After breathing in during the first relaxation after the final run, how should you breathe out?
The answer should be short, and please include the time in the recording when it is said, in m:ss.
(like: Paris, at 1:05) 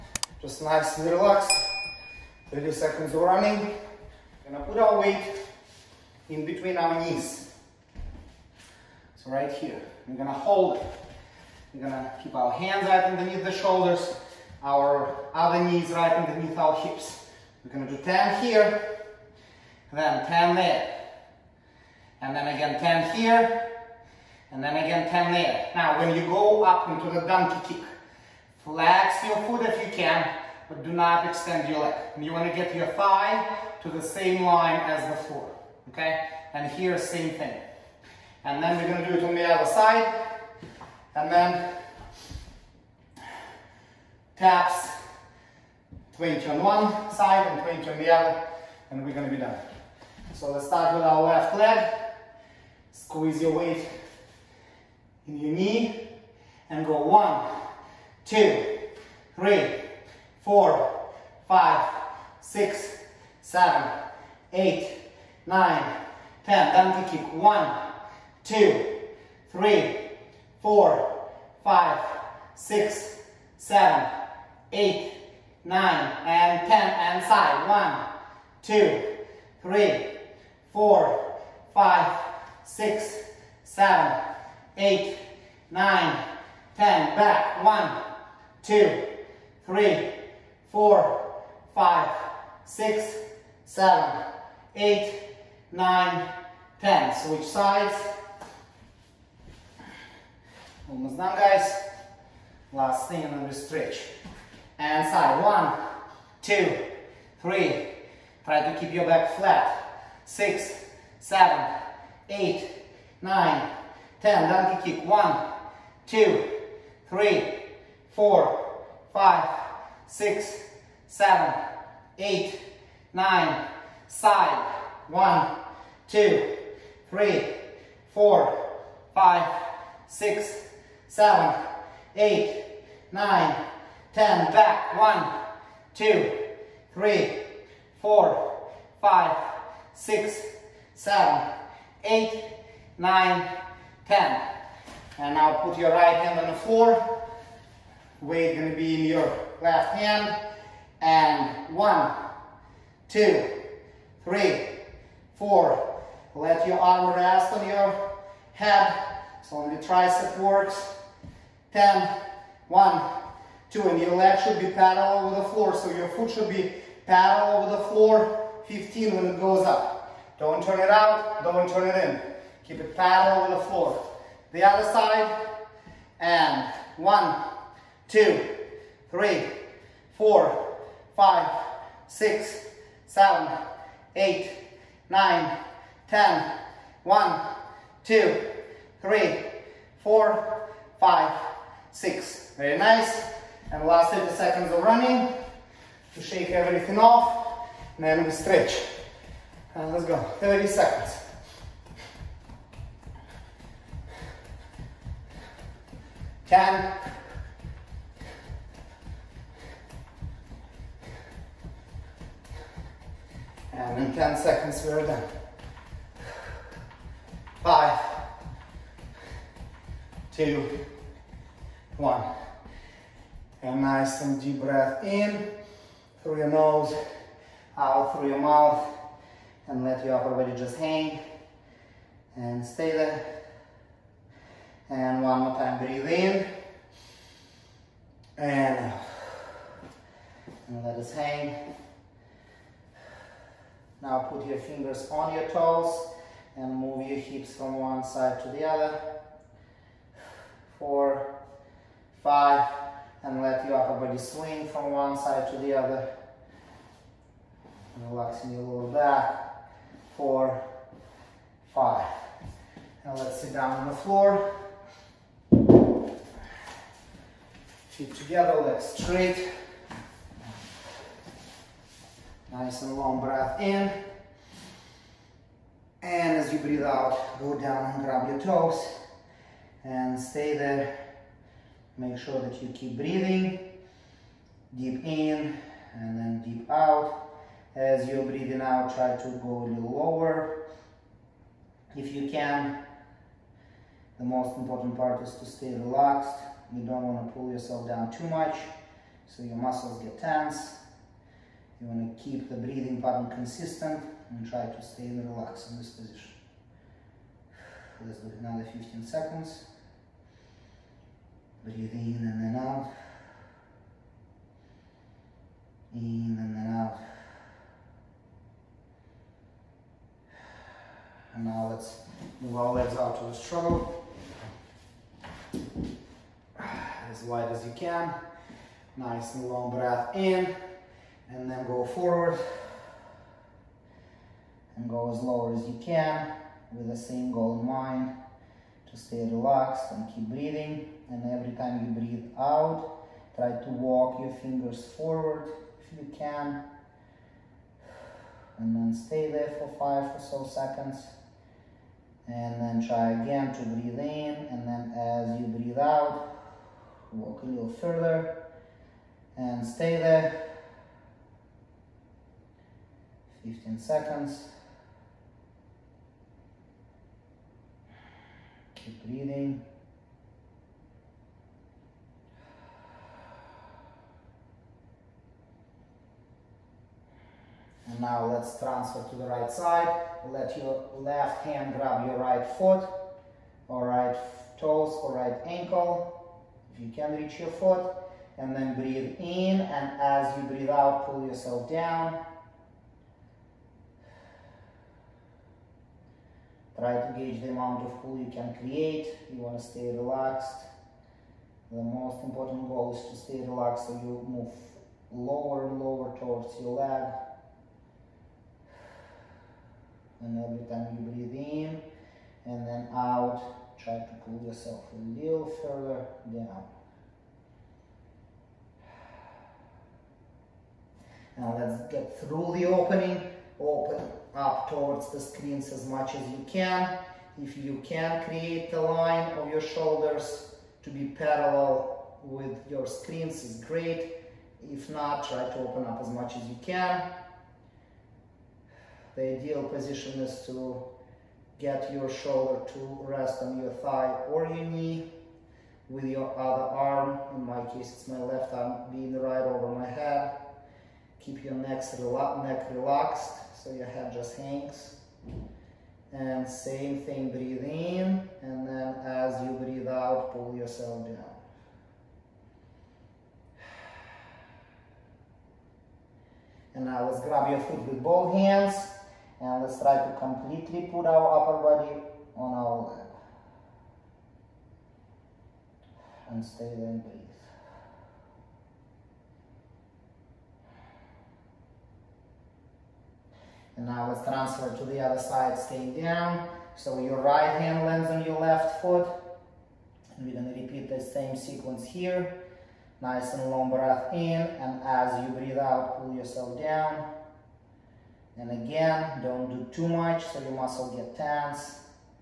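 through your mouth, at 3:47.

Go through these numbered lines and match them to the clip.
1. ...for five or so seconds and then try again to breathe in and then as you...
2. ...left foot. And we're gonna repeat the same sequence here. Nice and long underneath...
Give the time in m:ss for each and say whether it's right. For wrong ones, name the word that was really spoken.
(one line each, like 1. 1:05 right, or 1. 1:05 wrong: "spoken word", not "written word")
1. 5:49 right
2. 8:08 wrong: "breath", not "underneath".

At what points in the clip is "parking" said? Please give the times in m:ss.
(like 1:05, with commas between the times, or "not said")
not said.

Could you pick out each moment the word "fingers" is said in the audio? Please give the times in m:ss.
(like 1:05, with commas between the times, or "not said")
4:04, 5:44.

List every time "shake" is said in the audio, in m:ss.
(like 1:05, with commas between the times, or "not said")
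3:16.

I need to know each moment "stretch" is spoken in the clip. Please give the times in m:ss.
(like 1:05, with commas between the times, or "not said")
1:43, 3:18.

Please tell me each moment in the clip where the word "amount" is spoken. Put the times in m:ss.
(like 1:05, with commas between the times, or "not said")
6:37.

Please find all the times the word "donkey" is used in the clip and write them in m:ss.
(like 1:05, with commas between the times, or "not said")
0:27, 1:54.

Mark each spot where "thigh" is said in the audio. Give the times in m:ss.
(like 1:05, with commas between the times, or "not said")
0:32, 7:23.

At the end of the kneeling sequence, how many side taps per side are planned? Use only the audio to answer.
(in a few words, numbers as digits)
20.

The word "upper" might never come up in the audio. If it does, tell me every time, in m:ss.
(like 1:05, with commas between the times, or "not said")
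3:50, 4:13, 7:51.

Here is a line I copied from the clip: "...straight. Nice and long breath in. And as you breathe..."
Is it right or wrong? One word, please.
right.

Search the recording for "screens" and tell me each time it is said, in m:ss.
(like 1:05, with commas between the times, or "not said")
7:05, 7:12.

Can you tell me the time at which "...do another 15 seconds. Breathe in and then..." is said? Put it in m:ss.
5:08.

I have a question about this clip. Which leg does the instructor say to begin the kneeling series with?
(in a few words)
left leg.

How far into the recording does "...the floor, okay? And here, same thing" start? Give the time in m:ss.
0:35.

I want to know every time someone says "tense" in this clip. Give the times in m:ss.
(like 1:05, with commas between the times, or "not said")
5:00, 8:21.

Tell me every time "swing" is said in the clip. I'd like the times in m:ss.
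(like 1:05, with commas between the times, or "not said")
4:14.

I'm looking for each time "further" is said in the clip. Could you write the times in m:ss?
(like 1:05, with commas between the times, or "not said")
5:57, 6:55.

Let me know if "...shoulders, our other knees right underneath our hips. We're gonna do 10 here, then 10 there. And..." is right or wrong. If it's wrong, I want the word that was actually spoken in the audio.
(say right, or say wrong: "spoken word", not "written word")
right.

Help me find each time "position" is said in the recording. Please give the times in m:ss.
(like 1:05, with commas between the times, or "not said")
5:05, 7:19.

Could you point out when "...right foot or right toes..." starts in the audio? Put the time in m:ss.
6:22.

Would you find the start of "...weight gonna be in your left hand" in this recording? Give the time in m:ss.
2:28.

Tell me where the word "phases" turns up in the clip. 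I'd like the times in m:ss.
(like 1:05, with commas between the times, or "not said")
not said.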